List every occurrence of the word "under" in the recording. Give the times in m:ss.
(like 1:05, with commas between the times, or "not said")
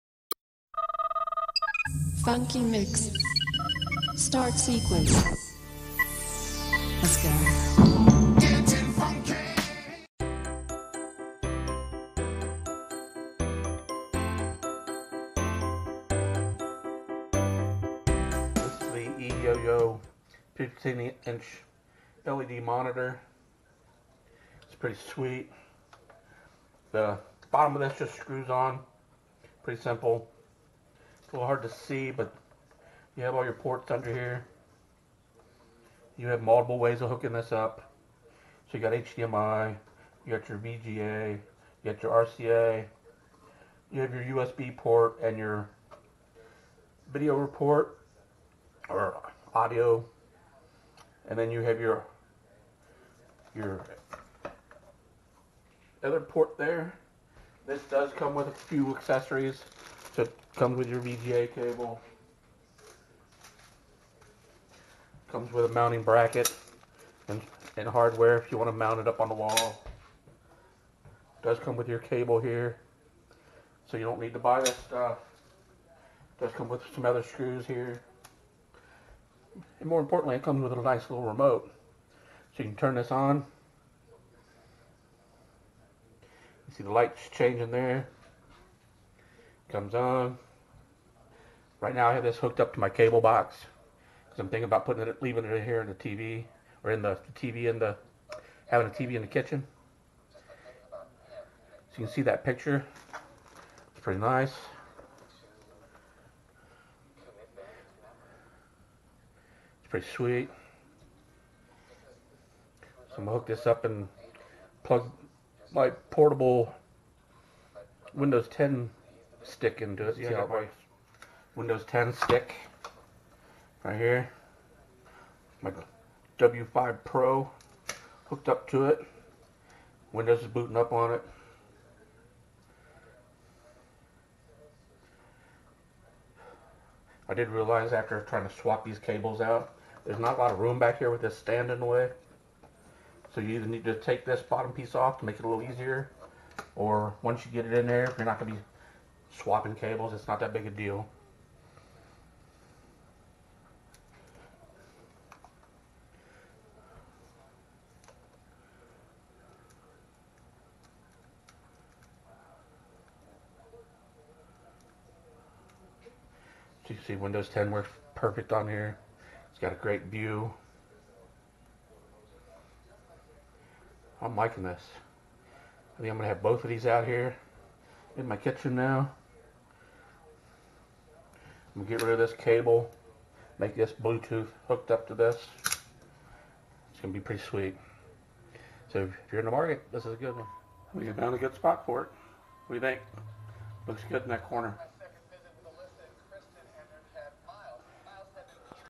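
0:33.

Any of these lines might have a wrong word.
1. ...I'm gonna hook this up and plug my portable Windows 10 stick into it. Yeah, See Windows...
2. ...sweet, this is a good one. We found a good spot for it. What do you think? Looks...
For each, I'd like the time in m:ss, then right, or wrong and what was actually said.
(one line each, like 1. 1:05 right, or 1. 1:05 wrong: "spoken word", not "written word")
1. 1:53 right
2. 3:09 wrong: "market", not "sweet".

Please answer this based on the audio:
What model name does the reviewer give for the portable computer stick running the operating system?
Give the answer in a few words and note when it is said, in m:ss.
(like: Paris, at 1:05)
W5 Pro, at 2:06.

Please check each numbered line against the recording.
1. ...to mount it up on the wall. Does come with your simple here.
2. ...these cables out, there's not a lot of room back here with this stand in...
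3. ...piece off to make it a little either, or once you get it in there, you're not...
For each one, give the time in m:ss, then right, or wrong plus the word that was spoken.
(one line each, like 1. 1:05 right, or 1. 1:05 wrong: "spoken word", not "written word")
1. 1:08 wrong: "cable", not "simple"
2. 2:18 right
3. 2:24 wrong: "easier", not "either".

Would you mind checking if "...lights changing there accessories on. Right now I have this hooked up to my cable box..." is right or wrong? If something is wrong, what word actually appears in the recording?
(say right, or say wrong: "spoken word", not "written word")
wrong: "comes", not "accessories".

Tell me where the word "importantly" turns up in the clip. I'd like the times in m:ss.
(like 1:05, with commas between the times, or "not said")
1:20.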